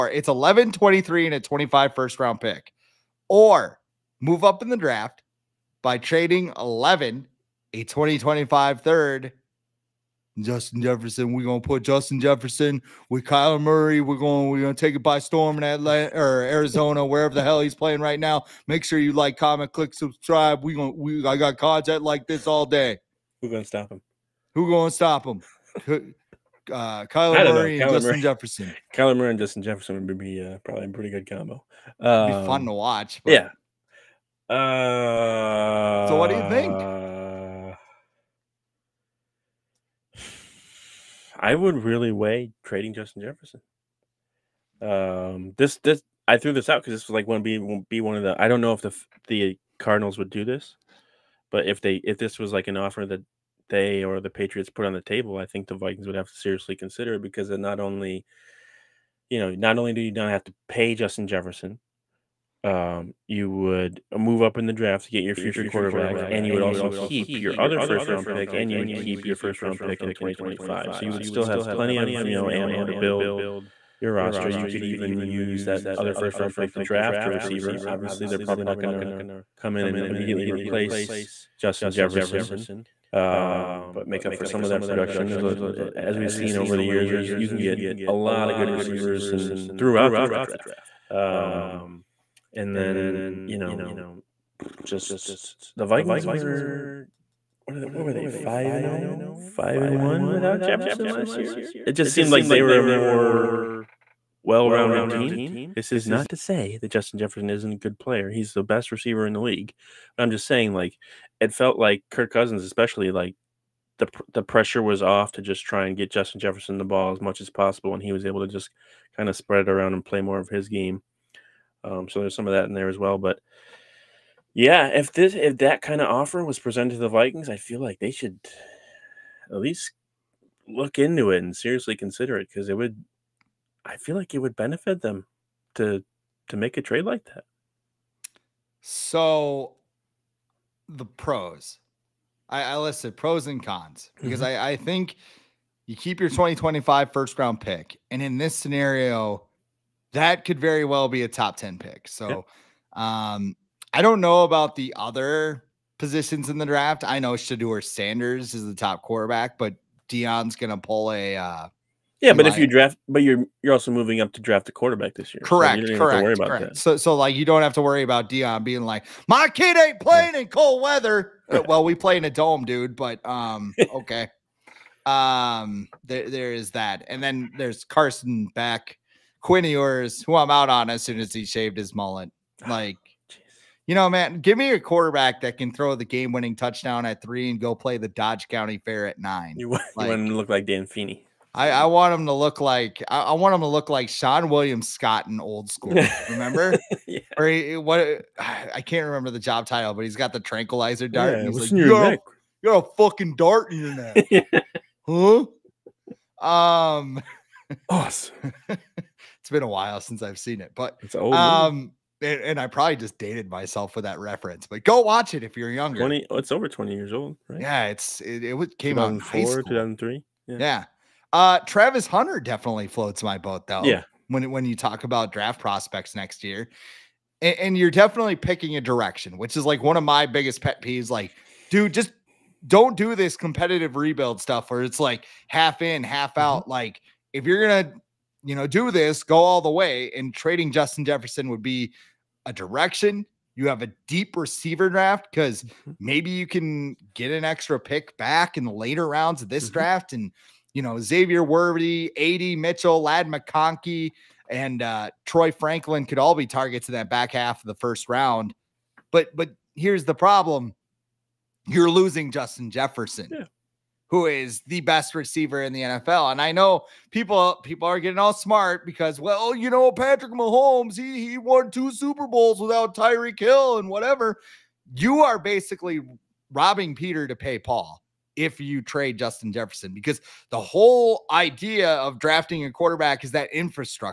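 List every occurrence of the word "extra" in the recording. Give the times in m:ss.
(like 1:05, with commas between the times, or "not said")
4:07.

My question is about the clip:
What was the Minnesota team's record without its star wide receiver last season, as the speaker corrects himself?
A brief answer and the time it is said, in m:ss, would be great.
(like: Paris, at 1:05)
5-1, at 1:39.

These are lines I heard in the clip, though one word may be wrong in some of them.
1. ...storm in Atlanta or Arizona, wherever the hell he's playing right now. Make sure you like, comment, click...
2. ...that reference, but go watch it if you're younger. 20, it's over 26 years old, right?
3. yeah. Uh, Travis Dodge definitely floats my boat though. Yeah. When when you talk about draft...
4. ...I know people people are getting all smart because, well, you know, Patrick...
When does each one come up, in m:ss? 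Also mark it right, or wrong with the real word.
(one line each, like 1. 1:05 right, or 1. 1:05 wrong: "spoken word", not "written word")
1. 0:15 right
2. 3:34 wrong: "20", not "26"
3. 3:40 wrong: "Hunter", not "Dodge"
4. 4:26 right.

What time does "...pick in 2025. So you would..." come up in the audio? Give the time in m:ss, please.
1:09.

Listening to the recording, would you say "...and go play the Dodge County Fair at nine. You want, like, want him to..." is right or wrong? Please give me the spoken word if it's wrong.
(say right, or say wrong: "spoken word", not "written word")
right.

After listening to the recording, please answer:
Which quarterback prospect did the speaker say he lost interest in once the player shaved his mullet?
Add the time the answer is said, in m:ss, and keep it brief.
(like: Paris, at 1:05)
Quinn Ewers, at 2:59.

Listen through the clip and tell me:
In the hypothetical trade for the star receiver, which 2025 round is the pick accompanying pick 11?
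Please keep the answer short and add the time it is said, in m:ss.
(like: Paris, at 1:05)
Third, at 0:07.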